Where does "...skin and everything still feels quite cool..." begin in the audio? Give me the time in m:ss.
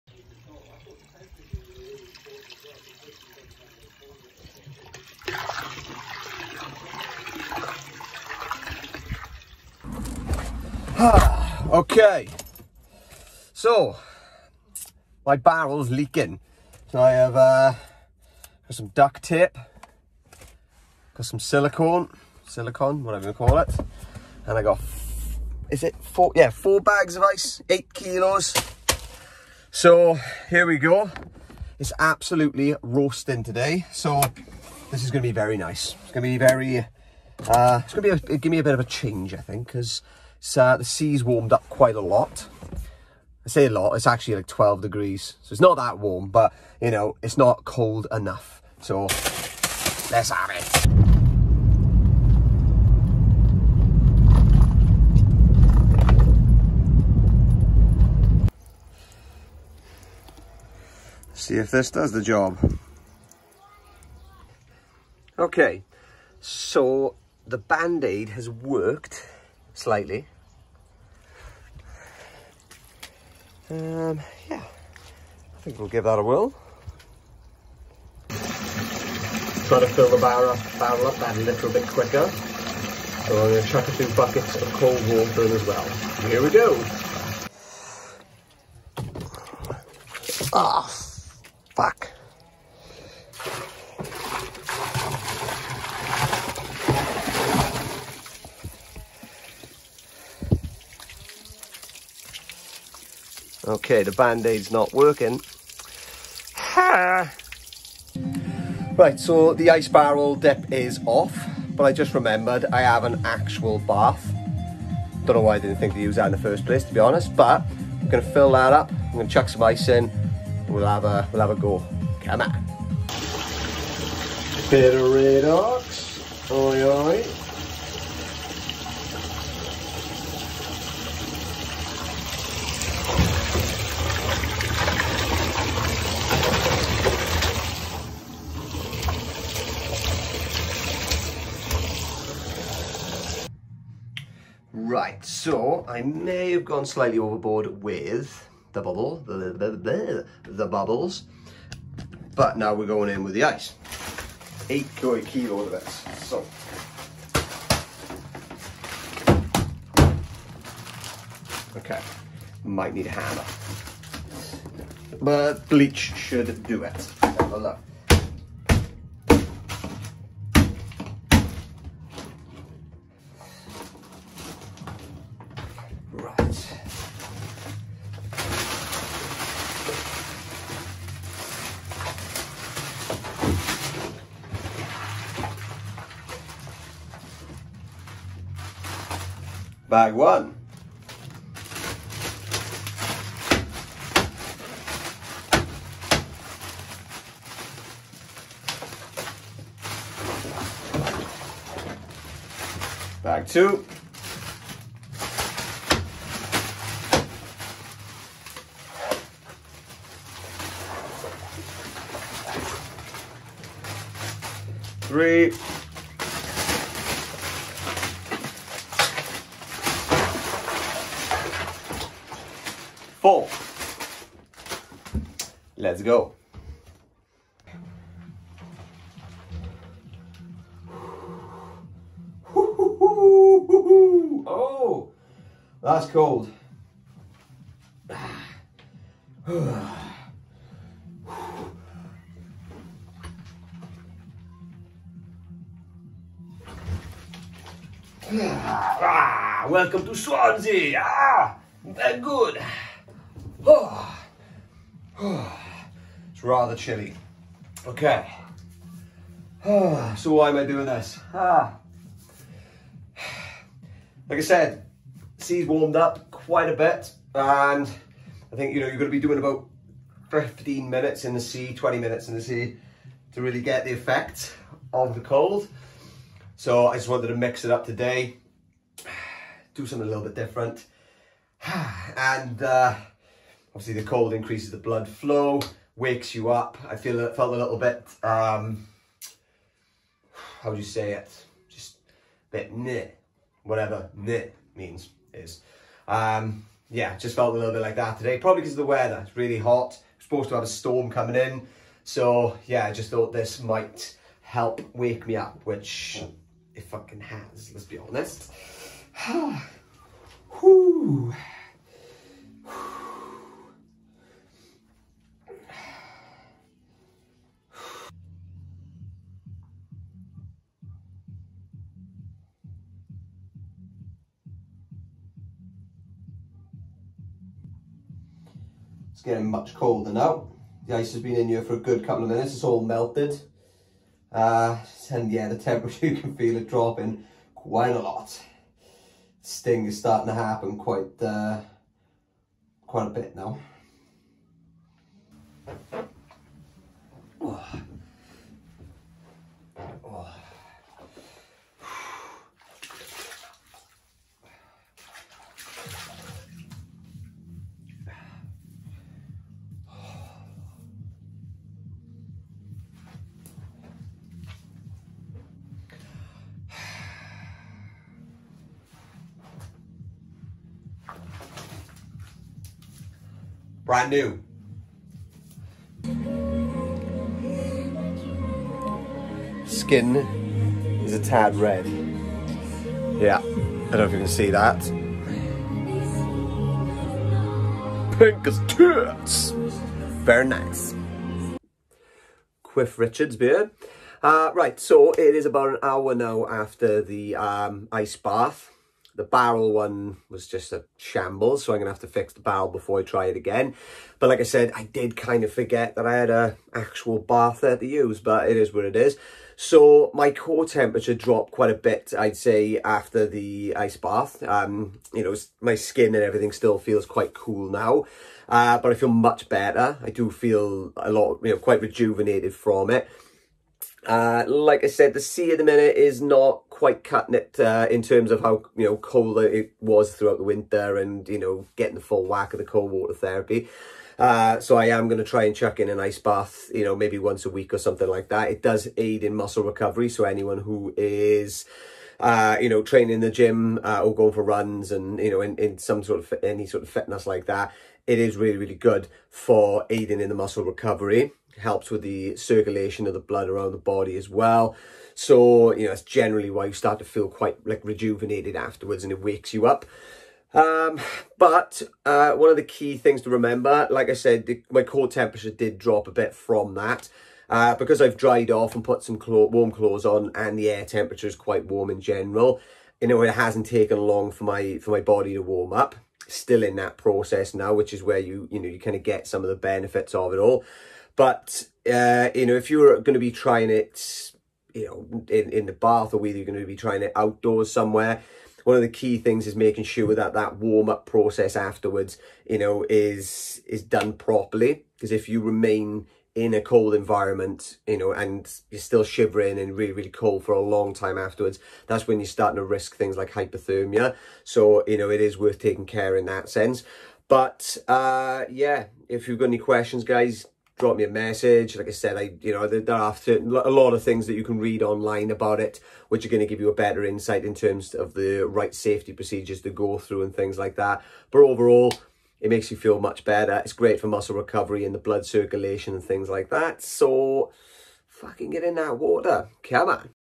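6:55.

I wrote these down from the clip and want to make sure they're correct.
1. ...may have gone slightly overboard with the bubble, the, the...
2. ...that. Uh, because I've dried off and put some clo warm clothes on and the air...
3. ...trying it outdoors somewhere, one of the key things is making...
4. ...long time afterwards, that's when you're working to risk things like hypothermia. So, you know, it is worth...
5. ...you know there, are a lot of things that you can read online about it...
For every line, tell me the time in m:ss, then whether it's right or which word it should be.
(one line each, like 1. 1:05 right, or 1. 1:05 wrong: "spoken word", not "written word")
1. 2:26 right
2. 7:46 right
3. 8:06 right
4. 8:20 wrong: "starting", not "working"
5. 8:32 right.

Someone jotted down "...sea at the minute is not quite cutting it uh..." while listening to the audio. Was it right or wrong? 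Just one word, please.
right.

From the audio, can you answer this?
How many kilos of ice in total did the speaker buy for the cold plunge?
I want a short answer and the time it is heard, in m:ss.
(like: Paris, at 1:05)
8 kilos, at 0:27.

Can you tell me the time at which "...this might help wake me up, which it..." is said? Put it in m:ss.
5:03.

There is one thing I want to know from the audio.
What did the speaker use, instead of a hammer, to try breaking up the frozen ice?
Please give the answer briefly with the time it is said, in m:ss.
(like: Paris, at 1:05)
Bleach, at 2:45.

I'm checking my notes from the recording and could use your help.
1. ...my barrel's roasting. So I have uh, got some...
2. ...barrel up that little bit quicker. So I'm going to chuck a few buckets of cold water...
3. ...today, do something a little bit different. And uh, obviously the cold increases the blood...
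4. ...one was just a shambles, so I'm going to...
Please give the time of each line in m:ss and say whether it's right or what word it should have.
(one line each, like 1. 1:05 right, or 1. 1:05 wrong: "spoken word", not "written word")
1. 0:15 wrong: "leaking", not "roasting"
2. 1:20 right
3. 4:37 right
4. 6:39 right.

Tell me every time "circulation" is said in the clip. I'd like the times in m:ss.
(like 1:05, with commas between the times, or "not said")
7:32, 8:45.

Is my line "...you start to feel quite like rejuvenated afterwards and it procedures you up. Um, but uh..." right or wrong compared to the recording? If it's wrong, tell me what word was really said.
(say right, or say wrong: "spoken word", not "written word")
wrong: "wakes", not "procedures".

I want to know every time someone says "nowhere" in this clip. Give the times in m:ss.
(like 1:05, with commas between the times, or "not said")
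not said.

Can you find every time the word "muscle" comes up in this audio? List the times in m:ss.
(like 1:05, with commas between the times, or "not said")
7:19, 7:30, 8:44.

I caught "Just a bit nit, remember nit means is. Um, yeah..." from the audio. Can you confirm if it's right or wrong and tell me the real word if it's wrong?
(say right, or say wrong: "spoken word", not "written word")
wrong: "whatever", not "remember".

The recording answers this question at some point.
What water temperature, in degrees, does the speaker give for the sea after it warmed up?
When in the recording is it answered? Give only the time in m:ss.
0:44.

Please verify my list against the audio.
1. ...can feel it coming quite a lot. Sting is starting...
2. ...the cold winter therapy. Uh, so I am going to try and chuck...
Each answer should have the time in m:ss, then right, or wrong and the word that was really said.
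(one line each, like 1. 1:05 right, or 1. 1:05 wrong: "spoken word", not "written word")
1. 5:36 wrong: "dropping", not "coming"
2. 7:12 wrong: "water", not "winter".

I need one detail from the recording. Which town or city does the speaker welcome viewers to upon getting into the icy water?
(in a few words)
Swansea.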